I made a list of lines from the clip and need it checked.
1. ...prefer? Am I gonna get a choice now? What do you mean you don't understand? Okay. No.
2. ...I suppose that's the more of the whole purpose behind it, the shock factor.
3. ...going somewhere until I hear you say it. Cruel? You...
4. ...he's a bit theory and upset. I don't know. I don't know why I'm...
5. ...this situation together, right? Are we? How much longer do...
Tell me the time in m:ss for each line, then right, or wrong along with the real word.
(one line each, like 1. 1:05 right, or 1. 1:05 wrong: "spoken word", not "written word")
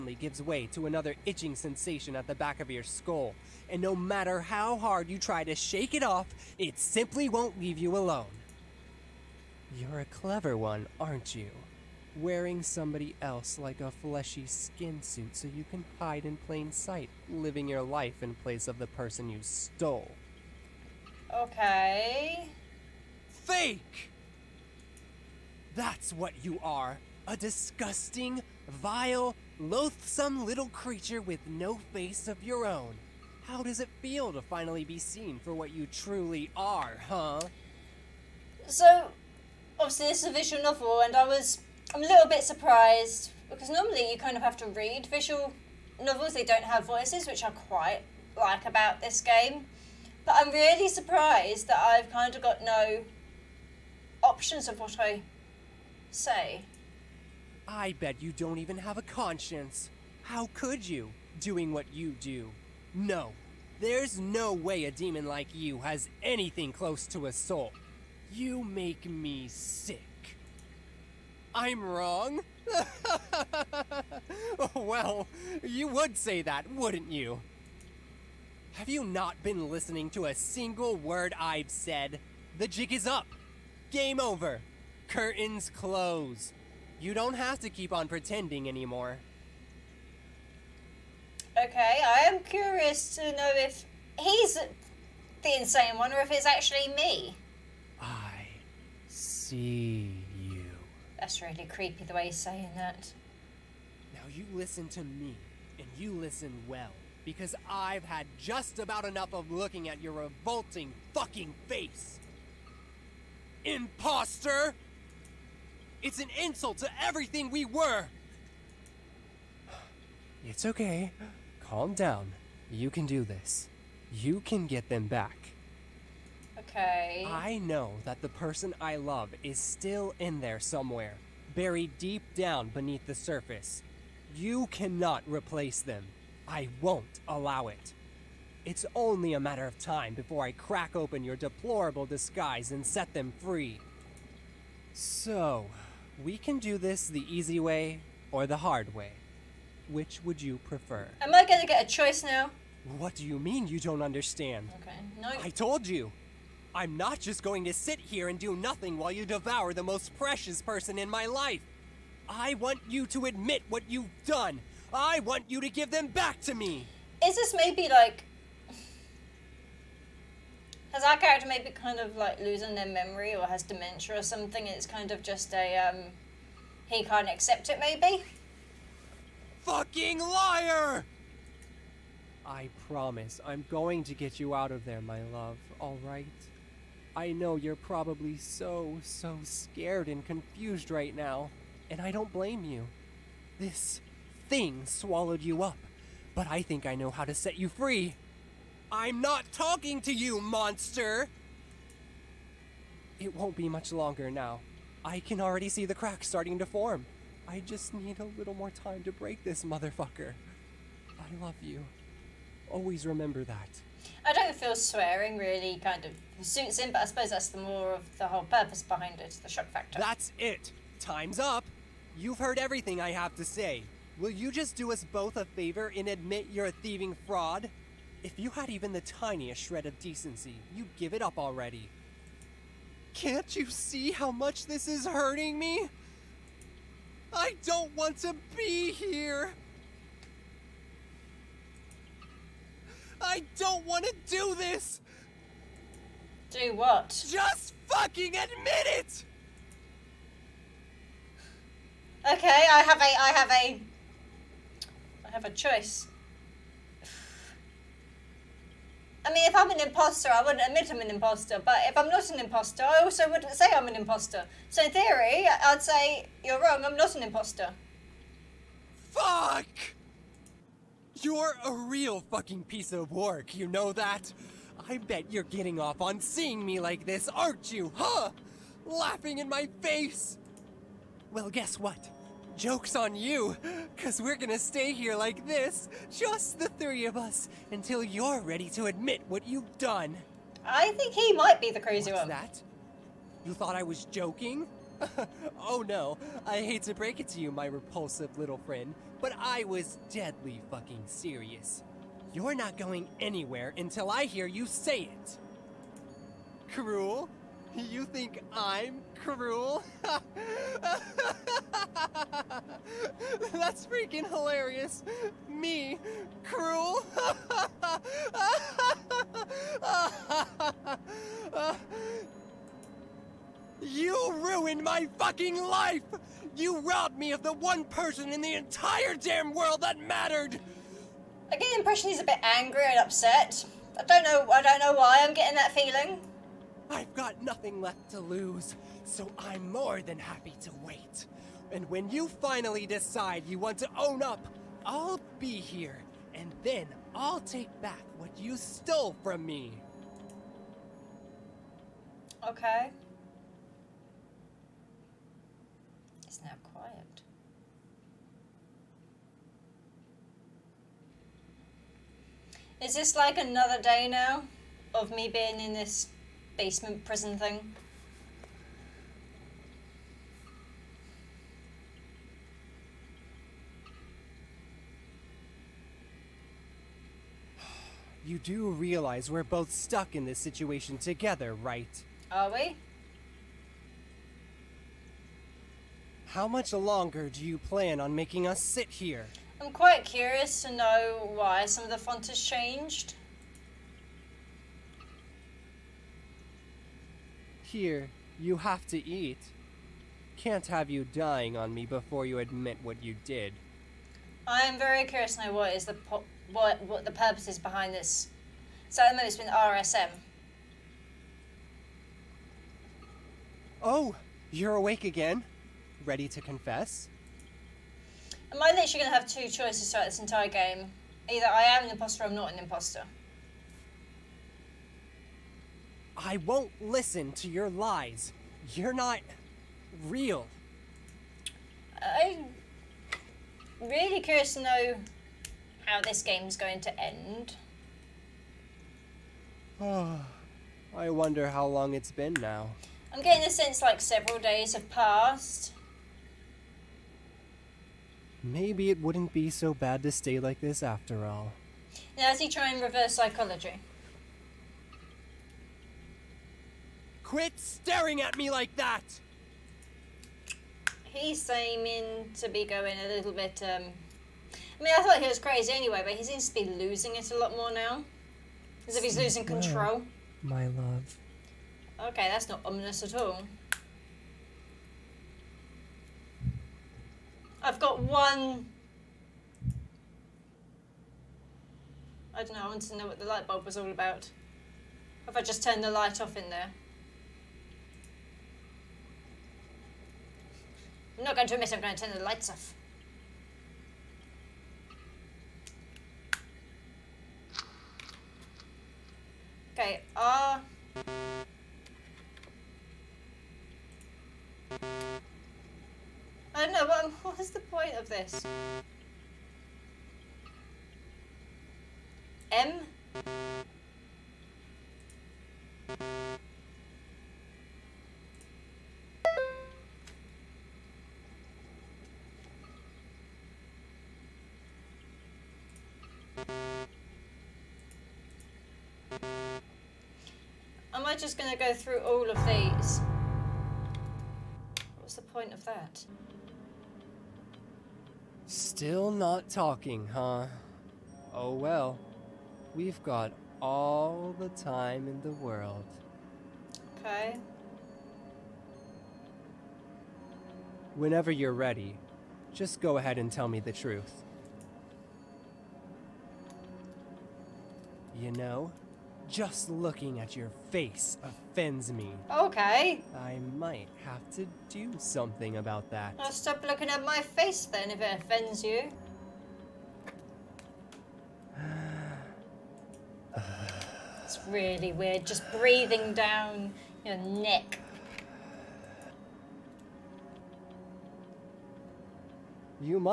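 1. 2:30 right
2. 3:37 right
3. 5:02 wrong: "anywhere", not "somewhere"
4. 5:32 wrong: "angry", not "theory"
5. 6:20 right.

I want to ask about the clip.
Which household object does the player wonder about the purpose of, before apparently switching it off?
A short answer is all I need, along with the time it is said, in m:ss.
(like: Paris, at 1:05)
light bulb, at 8:03.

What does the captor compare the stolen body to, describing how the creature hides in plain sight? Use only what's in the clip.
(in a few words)
fleshy skin suit.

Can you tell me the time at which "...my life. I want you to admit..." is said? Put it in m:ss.
2:41.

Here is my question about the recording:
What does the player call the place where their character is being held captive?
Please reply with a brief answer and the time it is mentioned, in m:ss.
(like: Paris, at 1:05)
basement prison, at 6:06.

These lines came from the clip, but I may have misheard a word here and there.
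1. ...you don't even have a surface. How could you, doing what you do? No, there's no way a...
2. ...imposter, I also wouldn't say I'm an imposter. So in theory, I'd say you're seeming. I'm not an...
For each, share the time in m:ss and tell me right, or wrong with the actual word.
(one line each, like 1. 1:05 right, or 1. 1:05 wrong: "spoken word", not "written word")
1. 0:58 wrong: "conscience", not "surface"
2. 4:22 wrong: "wrong", not "seeming".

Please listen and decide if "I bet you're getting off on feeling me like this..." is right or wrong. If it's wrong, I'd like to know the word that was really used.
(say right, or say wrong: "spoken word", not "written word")
wrong: "seeing", not "feeling".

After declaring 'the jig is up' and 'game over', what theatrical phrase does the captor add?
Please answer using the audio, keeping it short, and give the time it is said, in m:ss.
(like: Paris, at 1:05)
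Curtains close, at 1:25.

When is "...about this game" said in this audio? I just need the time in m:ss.
0:48.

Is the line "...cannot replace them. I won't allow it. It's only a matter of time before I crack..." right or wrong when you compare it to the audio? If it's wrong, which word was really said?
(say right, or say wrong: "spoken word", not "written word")
right.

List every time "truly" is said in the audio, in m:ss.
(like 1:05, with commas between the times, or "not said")
0:35.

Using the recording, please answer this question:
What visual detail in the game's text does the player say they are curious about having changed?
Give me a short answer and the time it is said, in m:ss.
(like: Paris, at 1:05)
the font, at 6:31.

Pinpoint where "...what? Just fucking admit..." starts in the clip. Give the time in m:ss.
4:06.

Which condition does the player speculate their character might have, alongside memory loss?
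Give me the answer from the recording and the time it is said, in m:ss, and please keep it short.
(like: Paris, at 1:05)
dementia, at 2:53.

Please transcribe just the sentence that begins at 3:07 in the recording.
I know you're probably so, so scared and confused right now, and I don't blame you.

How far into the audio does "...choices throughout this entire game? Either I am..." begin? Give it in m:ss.
6:59.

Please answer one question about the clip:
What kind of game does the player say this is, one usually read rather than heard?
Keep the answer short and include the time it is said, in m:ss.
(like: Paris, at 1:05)
visual novel, at 0:40.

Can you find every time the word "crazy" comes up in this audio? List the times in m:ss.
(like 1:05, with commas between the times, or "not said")
4:51, 7:45.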